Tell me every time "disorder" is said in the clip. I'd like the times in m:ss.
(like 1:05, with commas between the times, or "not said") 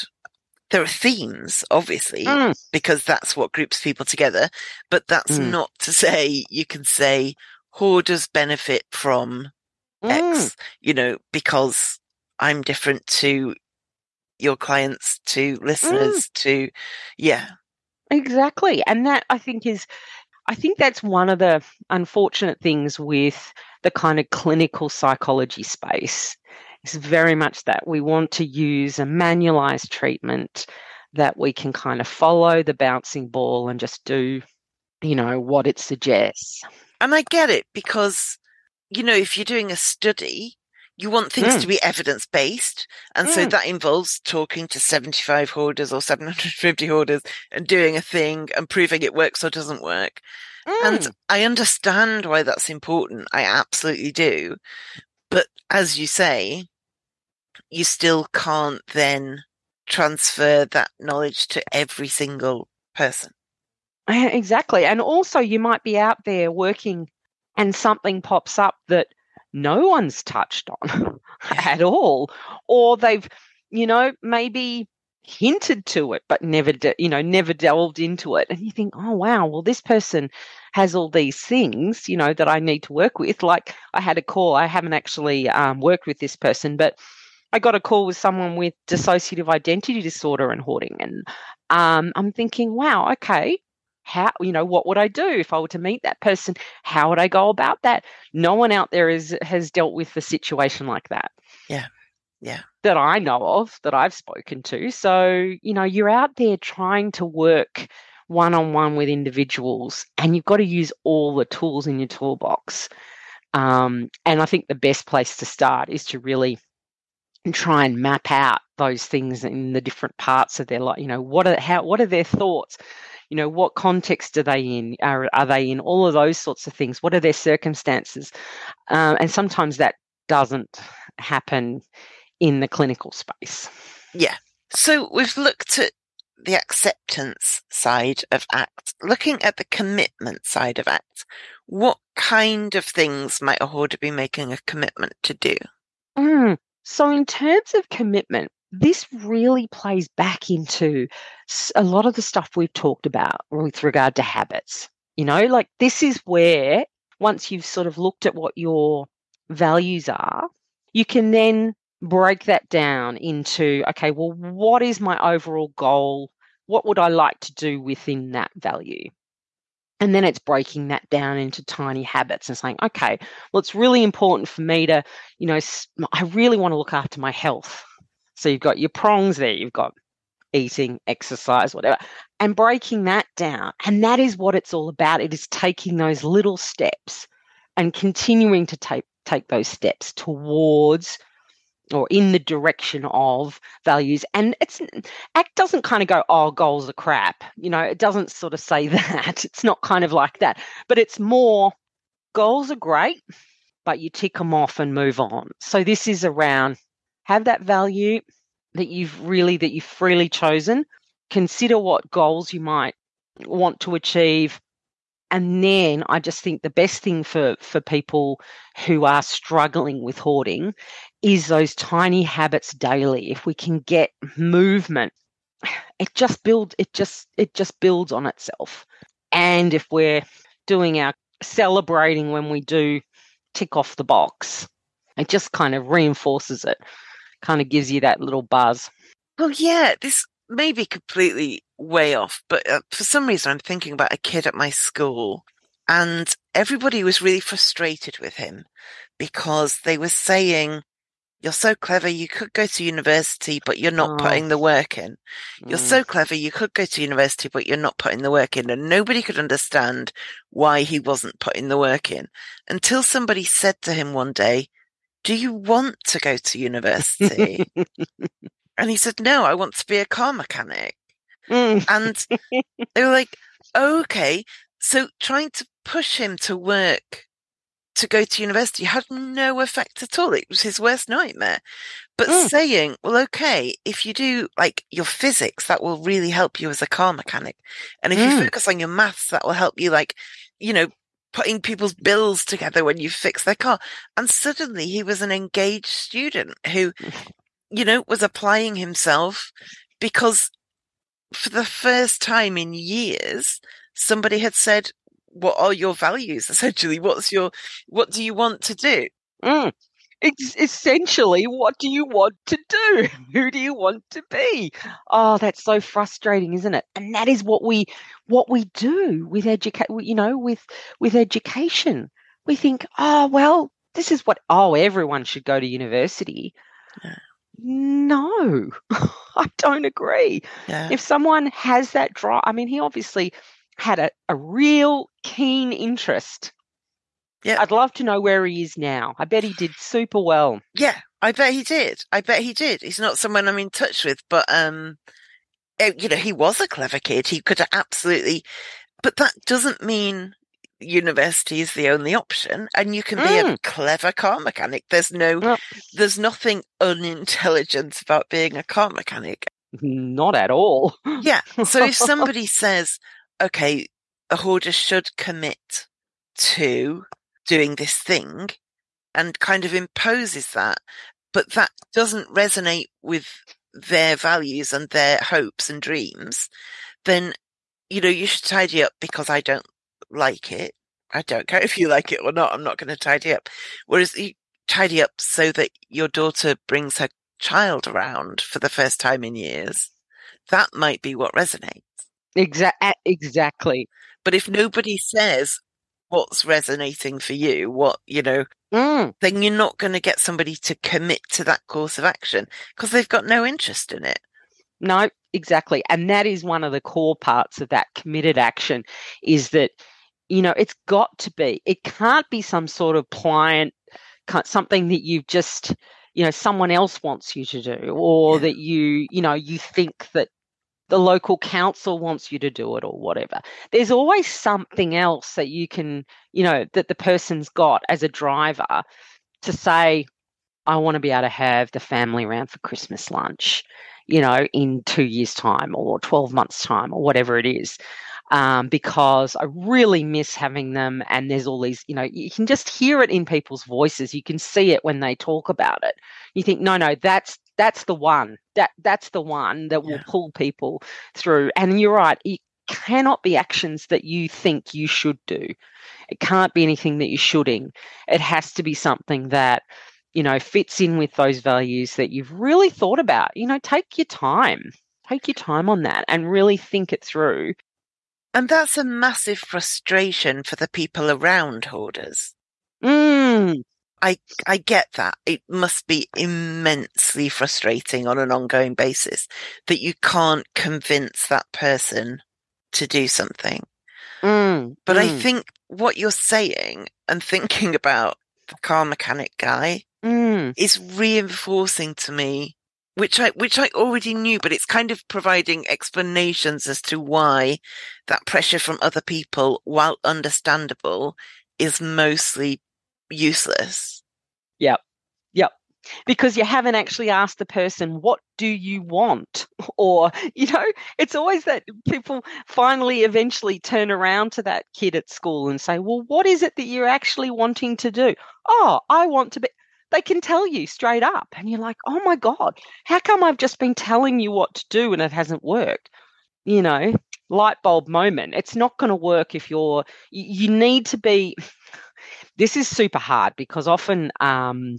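1:30.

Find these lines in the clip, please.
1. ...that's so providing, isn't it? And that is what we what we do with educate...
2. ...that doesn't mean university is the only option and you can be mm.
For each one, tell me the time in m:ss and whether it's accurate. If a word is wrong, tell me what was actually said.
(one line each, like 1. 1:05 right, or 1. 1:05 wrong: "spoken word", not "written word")
1. 5:15 wrong: "frustrating", not "providing"
2. 5:49 right.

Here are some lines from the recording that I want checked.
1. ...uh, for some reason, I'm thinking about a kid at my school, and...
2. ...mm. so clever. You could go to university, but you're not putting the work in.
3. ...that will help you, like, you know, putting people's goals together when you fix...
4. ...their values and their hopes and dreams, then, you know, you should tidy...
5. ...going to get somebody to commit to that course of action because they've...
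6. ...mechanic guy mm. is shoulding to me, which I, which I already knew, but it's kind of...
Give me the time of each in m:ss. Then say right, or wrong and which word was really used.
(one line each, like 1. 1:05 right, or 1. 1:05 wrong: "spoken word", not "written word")
1. 4:02 right
2. 4:15 right
3. 4:49 wrong: "bills", not "goals"
4. 6:13 right
5. 6:39 right
6. 8:08 wrong: "reinforcing", not "shoulding".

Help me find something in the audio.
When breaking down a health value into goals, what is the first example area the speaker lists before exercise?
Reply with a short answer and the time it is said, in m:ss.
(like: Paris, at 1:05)
eating, at 3:00.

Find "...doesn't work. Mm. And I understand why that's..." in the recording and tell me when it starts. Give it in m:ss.
0:49.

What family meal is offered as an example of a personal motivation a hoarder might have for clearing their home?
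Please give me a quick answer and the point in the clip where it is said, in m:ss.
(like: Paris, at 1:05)
Christmas lunch, at 7:12.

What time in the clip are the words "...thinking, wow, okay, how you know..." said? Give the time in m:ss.
1:32.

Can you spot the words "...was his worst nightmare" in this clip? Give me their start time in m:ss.
4:40.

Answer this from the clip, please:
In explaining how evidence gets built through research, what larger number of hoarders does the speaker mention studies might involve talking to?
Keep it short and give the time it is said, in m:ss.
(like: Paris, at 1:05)
750, at 0:46.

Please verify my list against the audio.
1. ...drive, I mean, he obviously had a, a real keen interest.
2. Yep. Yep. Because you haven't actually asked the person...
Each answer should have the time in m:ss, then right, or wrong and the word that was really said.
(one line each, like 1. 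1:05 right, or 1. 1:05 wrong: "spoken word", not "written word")
1. 5:32 right
2. 8:24 right.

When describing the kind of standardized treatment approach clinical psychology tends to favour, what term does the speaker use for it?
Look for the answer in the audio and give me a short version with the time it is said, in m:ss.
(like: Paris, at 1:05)
manualized treatment, at 0:29.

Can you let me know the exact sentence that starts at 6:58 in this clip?
that you you know you think that the local council wants you to do it or whatever.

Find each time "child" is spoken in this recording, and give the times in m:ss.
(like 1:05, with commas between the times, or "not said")
6:27.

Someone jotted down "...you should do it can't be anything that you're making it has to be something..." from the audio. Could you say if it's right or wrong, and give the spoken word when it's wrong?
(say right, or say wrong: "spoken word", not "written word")
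wrong: "shoulding", not "making".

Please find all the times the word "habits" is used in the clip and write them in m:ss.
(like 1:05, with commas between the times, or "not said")
2:34, 2:52, 3:42.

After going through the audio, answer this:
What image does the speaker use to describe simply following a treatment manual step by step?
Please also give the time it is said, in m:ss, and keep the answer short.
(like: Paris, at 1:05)
follow the bouncing ball, at 0:32.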